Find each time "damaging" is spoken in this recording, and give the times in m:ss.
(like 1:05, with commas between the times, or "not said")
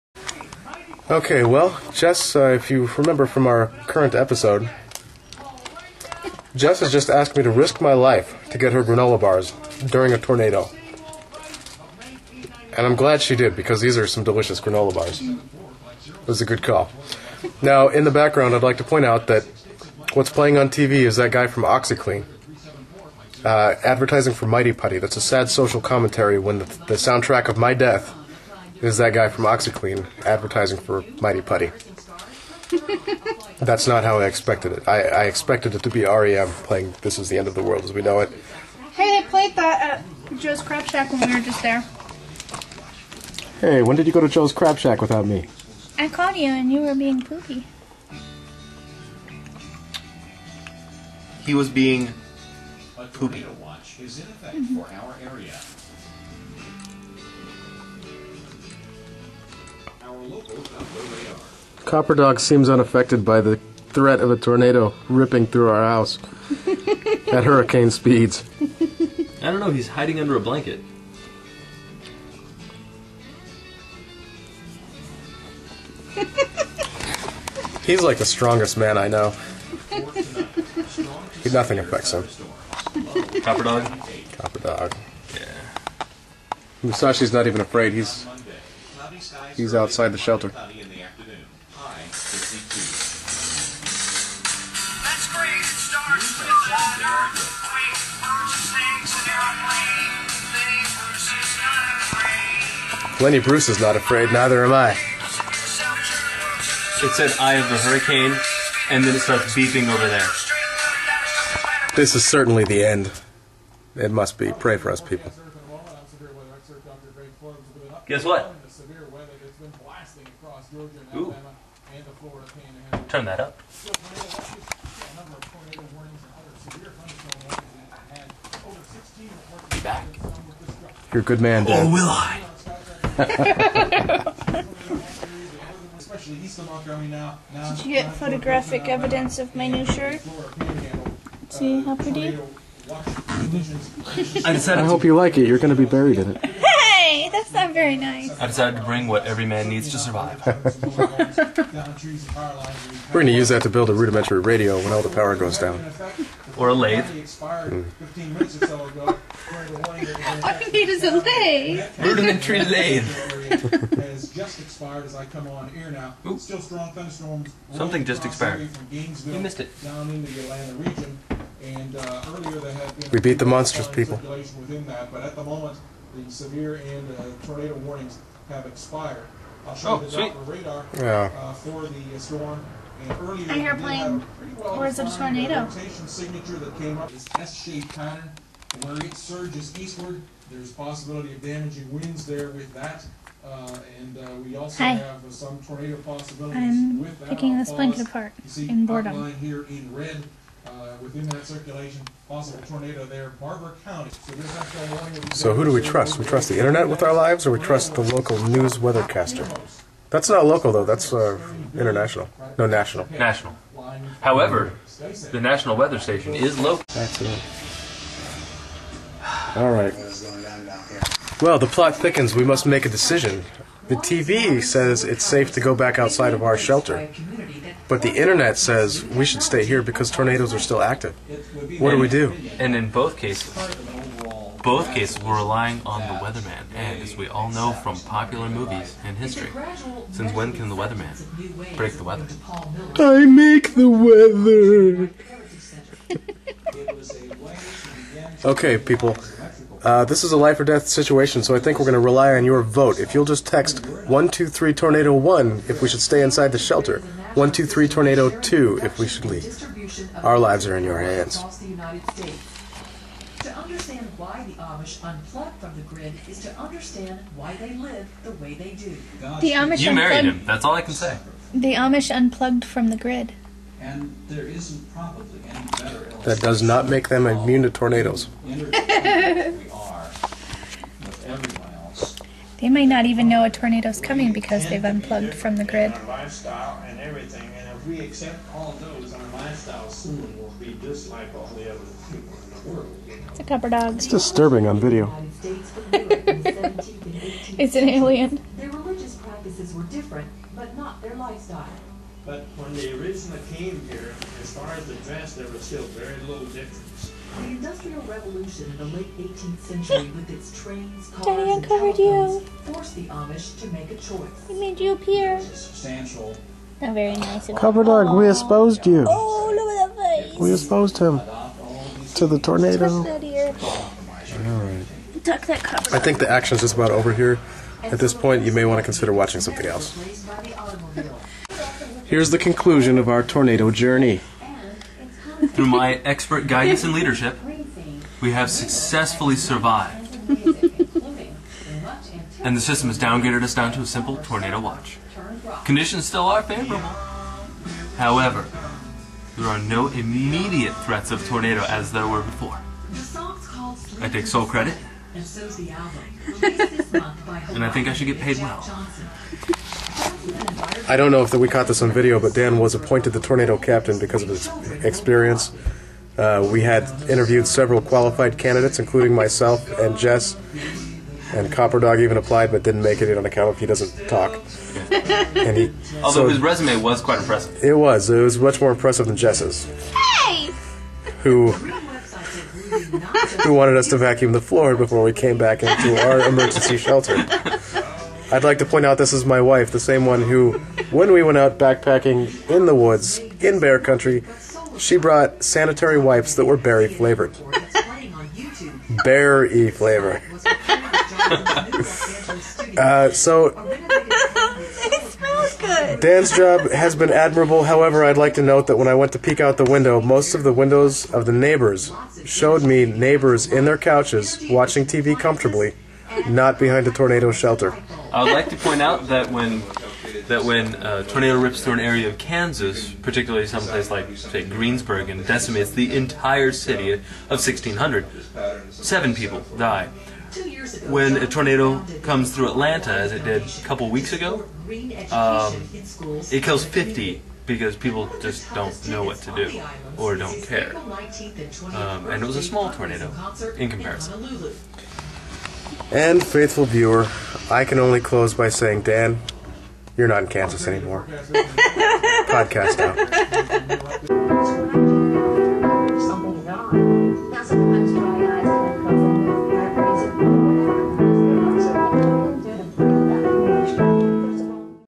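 3:11.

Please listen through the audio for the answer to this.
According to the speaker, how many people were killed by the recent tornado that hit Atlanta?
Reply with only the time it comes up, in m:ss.
7:16.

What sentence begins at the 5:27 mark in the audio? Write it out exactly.
At this point, you may want to consider watching something else.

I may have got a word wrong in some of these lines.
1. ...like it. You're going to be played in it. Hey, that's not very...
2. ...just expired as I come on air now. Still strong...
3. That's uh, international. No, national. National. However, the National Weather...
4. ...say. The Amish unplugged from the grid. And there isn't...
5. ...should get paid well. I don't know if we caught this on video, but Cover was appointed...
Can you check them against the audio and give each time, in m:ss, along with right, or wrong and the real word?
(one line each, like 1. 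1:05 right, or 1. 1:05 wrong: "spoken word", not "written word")
1. 2:25 wrong: "buried", not "played"
2. 2:44 right
3. 3:30 right
4. 4:30 right
5. 5:57 wrong: "Dan", not "Cover".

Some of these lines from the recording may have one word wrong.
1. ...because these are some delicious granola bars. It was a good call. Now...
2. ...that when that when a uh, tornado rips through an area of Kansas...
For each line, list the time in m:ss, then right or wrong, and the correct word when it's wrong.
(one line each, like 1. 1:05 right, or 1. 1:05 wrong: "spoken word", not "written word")
1. 0:13 right
2. 6:59 right.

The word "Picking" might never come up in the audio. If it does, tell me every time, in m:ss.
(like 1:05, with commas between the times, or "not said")
3:17.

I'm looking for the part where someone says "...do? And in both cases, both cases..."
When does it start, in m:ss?
3:52.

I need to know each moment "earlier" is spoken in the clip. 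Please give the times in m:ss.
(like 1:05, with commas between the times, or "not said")
2:52, 3:03.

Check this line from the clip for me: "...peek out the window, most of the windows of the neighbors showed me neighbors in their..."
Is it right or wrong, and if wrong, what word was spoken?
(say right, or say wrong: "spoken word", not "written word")
right.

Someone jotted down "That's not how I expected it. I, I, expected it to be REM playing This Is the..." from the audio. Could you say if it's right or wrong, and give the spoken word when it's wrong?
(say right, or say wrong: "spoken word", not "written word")
right.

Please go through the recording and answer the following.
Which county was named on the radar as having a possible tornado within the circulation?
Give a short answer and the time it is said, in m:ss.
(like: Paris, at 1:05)
Barbour County, at 3:23.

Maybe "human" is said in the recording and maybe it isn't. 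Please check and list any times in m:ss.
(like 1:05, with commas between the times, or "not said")
not said.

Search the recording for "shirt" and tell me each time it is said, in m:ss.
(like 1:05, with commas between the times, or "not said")
2:19.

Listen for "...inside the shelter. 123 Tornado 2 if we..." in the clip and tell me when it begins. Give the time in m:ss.
4:16.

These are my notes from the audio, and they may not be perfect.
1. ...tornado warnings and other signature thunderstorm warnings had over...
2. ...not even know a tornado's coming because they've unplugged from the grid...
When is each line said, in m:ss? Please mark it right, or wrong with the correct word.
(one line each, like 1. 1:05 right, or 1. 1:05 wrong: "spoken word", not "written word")
1. 2:05 wrong: "severe", not "signature"
2. 4:42 right.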